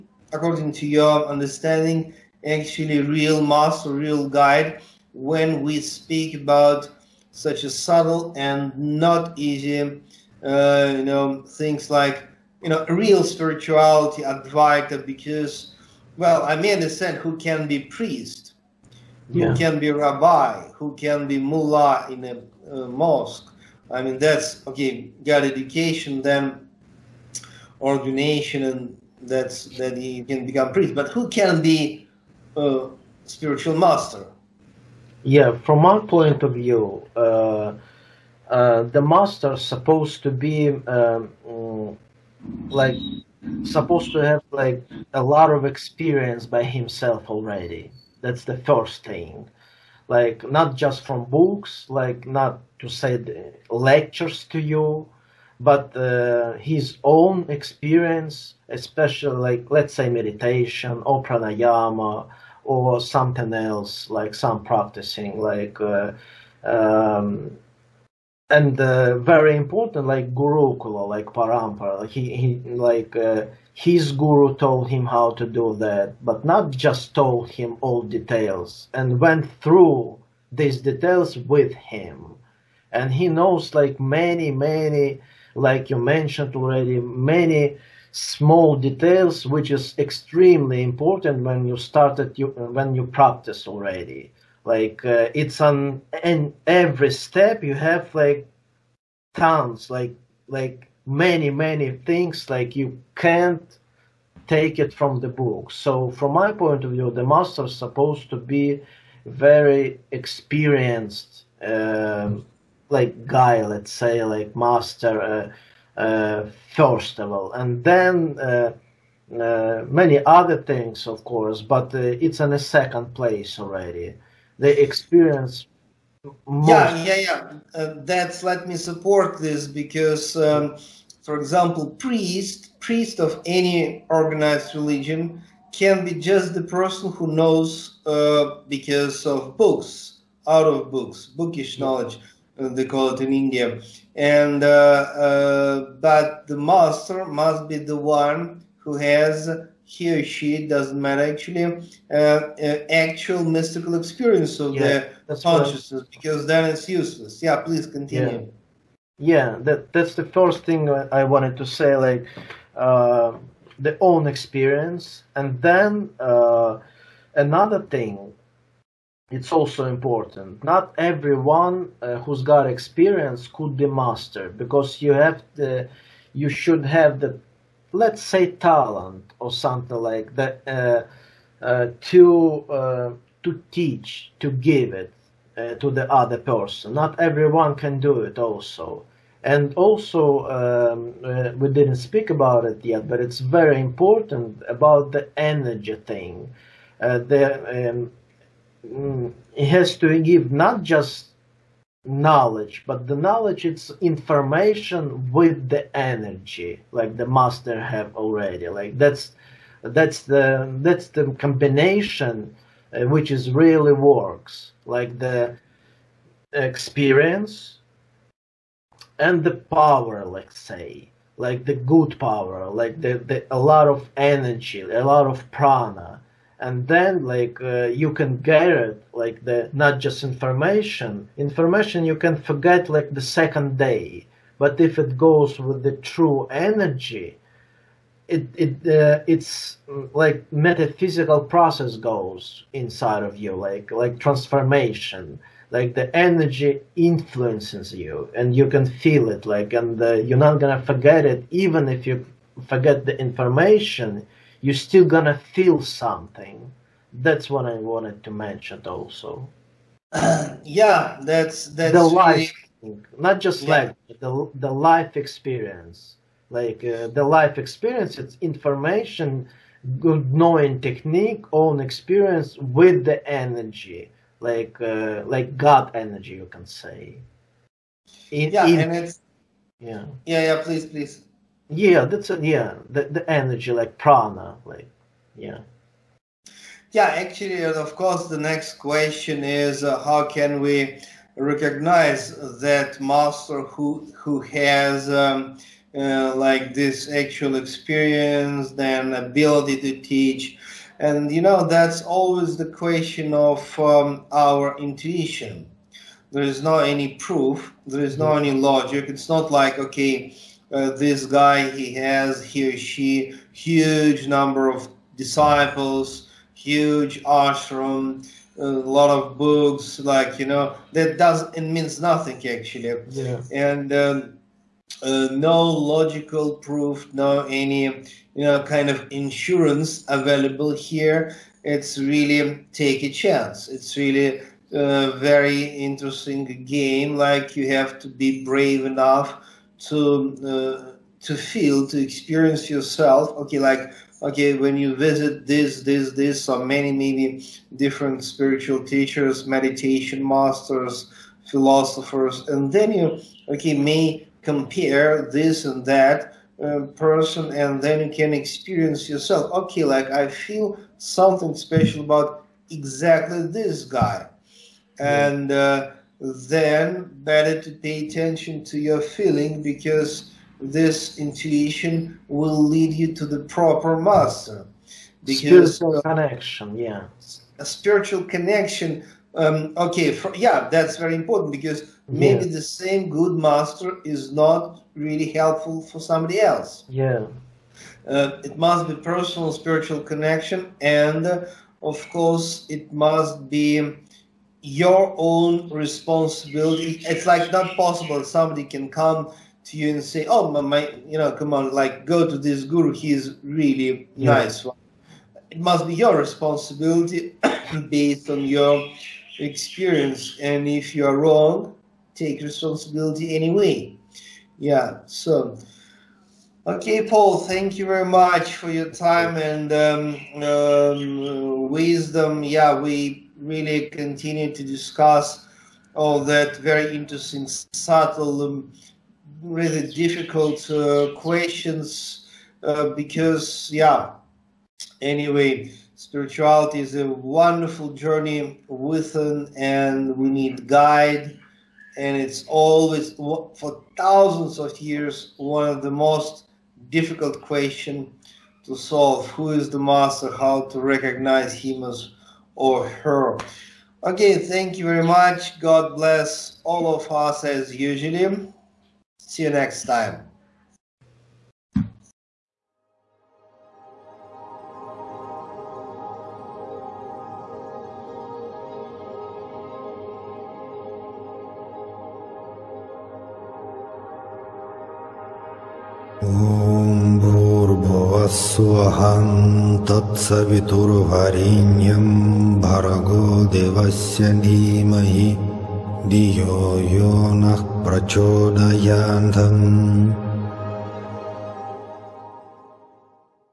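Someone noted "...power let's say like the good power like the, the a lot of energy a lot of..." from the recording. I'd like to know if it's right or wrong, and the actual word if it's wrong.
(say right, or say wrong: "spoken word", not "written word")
right.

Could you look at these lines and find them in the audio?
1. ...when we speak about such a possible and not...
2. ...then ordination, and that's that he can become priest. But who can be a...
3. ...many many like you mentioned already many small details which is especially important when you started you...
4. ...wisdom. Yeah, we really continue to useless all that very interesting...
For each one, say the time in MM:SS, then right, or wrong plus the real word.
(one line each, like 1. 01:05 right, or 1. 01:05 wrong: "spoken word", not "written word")
1. 00:05 wrong: "subtle", not "possible"
2. 00:26 right
3. 01:23 wrong: "extremely", not "especially"
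4. 07:01 wrong: "discuss", not "useless".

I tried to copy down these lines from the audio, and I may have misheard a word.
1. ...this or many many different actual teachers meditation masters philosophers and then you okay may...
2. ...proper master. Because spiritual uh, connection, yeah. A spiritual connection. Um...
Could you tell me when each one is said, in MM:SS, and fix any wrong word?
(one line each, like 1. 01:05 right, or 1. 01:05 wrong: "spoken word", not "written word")
1. 05:46 wrong: "spiritual", not "actual"
2. 06:13 right.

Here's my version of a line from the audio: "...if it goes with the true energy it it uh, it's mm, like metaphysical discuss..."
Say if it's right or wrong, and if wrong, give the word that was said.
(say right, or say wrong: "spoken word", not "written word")
wrong: "process", not "discuss".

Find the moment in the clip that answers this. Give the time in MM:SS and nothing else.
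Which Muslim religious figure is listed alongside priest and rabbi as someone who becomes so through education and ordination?
00:21.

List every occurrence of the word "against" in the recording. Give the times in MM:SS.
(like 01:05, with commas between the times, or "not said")
not said.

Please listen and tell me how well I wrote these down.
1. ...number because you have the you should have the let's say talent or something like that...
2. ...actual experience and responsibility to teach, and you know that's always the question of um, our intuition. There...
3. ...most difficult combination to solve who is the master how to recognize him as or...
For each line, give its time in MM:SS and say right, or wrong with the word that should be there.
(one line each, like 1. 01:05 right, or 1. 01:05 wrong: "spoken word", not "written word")
1. 02:53 wrong: "master", not "number"
2. 04:57 wrong: "ability", not "responsibility"
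3. 07:25 wrong: "question", not "combination".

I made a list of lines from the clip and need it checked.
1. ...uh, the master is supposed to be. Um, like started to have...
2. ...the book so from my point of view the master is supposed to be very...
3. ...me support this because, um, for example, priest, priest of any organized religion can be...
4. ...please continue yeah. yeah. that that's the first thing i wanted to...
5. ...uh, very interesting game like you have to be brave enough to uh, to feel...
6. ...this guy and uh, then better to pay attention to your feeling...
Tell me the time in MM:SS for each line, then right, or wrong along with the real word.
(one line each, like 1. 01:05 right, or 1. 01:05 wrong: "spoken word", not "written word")
1. 00:38 wrong: "supposed", not "started"
2. 01:45 right
3. 02:08 right
4. 02:37 right
5. 05:34 right
6. 06:03 right.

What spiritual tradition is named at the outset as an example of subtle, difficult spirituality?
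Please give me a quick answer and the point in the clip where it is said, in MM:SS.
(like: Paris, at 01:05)
Advaita, at 00:14.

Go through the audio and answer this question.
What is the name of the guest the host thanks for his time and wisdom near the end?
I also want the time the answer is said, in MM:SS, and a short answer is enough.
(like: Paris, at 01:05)
Paul, at 06:57.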